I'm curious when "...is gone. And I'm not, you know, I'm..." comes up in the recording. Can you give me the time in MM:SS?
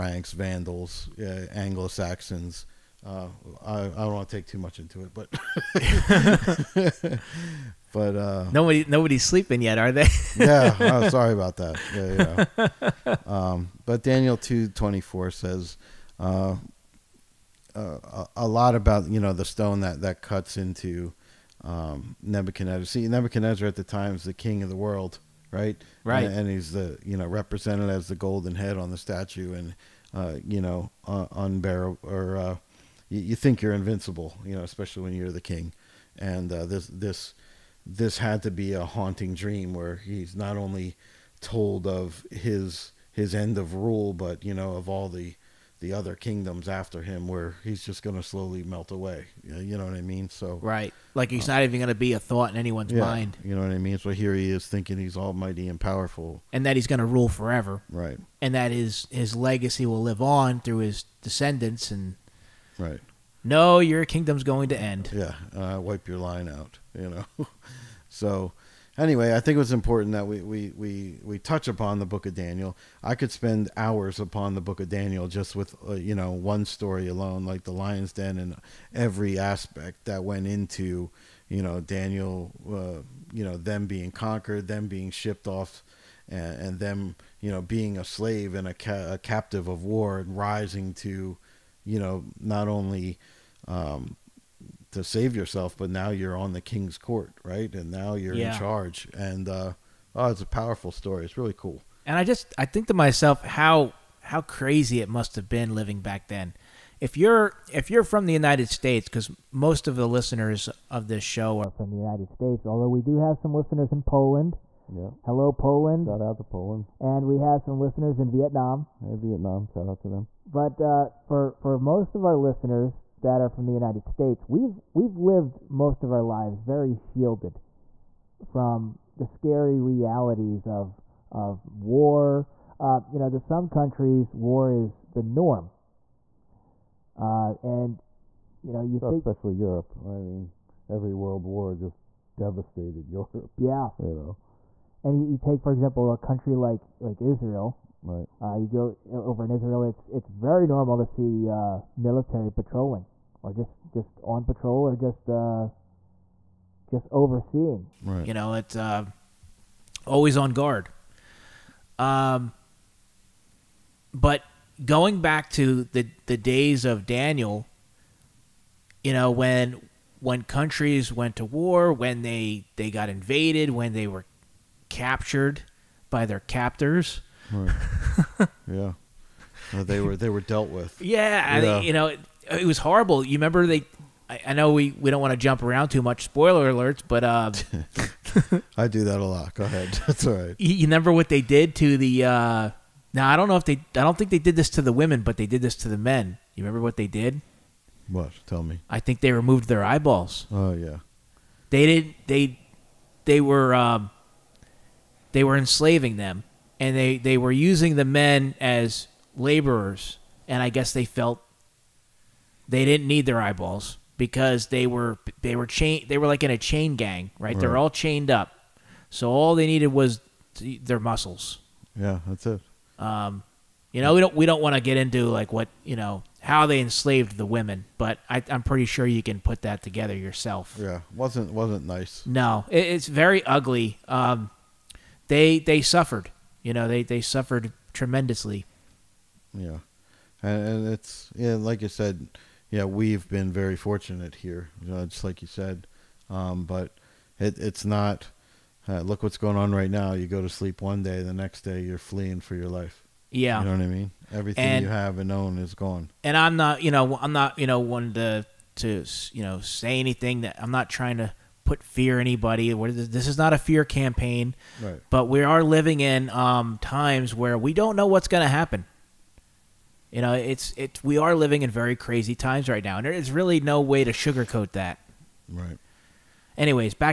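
04:15.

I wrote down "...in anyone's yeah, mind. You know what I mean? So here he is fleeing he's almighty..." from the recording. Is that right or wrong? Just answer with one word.
wrong.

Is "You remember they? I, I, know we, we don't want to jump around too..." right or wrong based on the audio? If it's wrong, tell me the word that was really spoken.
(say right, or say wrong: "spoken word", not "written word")
right.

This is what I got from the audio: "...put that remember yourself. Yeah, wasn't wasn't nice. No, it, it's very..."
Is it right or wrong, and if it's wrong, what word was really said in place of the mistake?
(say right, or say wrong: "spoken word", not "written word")
wrong: "together", not "remember".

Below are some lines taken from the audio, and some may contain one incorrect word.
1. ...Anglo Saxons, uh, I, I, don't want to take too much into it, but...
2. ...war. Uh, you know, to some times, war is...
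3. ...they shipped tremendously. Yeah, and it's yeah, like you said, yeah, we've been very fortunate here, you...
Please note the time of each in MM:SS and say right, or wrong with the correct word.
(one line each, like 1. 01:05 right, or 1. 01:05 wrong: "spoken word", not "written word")
1. 00:01 right
2. 02:11 wrong: "countries", not "times"
3. 03:57 wrong: "suffered", not "shipped".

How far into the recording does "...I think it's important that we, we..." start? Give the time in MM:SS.
01:09.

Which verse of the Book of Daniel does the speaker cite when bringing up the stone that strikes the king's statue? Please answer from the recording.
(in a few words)
Daniel 2:24.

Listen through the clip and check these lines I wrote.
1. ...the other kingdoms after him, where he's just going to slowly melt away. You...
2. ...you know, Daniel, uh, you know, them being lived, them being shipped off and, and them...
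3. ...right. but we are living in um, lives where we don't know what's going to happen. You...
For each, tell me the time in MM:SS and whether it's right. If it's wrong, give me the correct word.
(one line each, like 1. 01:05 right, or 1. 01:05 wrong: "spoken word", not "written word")
1. 00:45 right
2. 01:21 wrong: "conquered", not "lived"
3. 04:24 wrong: "times", not "lives".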